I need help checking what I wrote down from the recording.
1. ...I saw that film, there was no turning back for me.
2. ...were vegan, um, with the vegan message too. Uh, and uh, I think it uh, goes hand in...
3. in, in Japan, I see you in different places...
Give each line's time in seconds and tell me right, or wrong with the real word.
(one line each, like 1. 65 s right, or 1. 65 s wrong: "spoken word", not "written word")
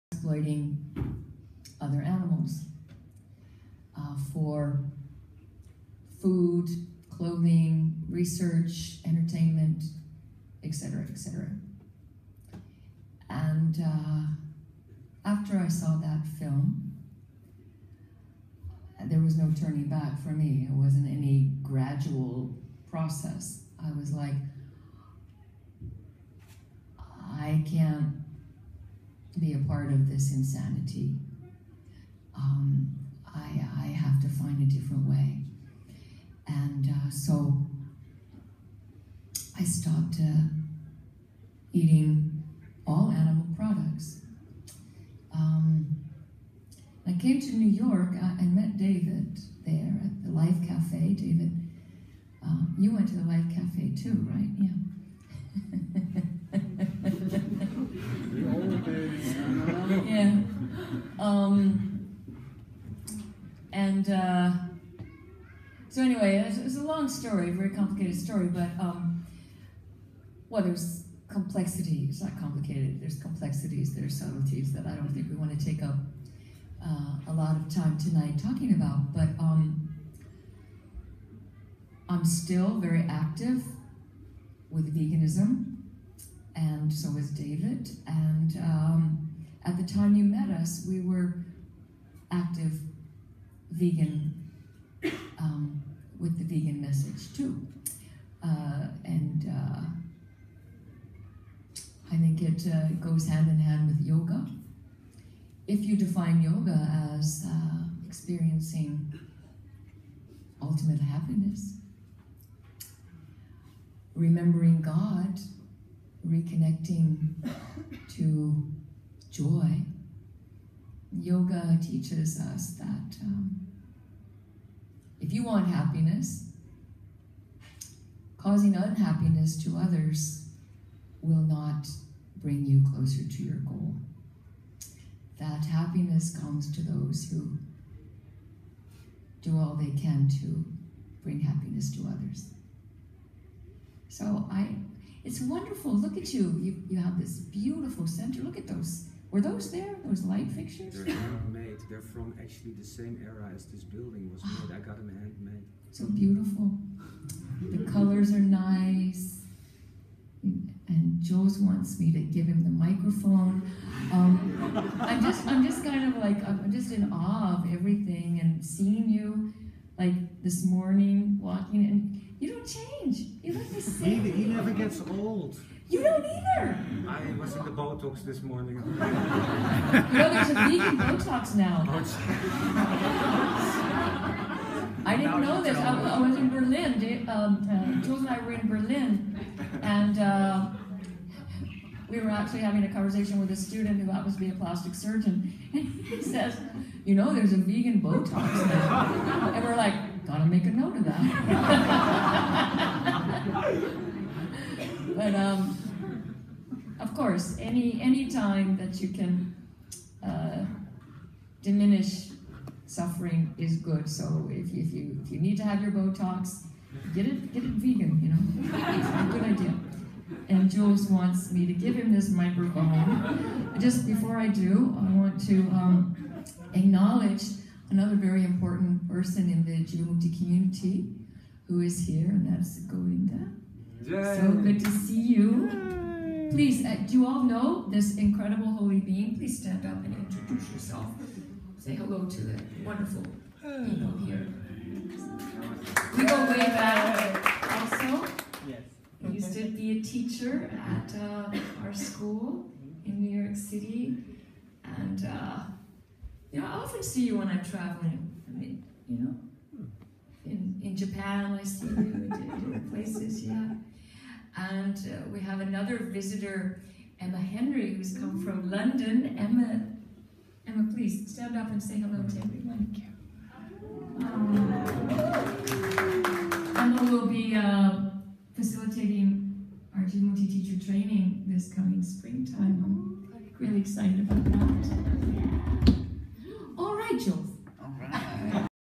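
1. 15 s right
2. 90 s right
3. 260 s right.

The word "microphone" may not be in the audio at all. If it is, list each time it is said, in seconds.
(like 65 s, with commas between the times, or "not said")
162 s, 222 s.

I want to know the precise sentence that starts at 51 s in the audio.
David, uh, you went to the Life Cafe too, right?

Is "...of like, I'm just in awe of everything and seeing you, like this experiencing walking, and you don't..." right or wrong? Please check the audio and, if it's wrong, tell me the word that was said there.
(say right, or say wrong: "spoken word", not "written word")
wrong: "morning", not "experiencing".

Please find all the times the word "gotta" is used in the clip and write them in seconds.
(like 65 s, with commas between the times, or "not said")
200 s.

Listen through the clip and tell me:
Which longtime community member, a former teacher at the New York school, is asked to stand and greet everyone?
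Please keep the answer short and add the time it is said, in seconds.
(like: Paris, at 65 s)
Govinda, at 232 s.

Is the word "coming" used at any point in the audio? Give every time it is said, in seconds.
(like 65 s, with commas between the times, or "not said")
281 s.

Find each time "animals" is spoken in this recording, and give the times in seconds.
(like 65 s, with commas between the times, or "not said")
2 s, 43 s.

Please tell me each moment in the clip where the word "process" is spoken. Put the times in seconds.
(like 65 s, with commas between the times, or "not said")
22 s.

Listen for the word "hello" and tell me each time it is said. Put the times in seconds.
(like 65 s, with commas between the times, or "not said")
241 s, 271 s.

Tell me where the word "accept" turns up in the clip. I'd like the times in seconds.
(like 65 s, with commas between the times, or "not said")
not said.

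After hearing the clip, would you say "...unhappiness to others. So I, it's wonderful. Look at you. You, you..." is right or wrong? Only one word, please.
wrong.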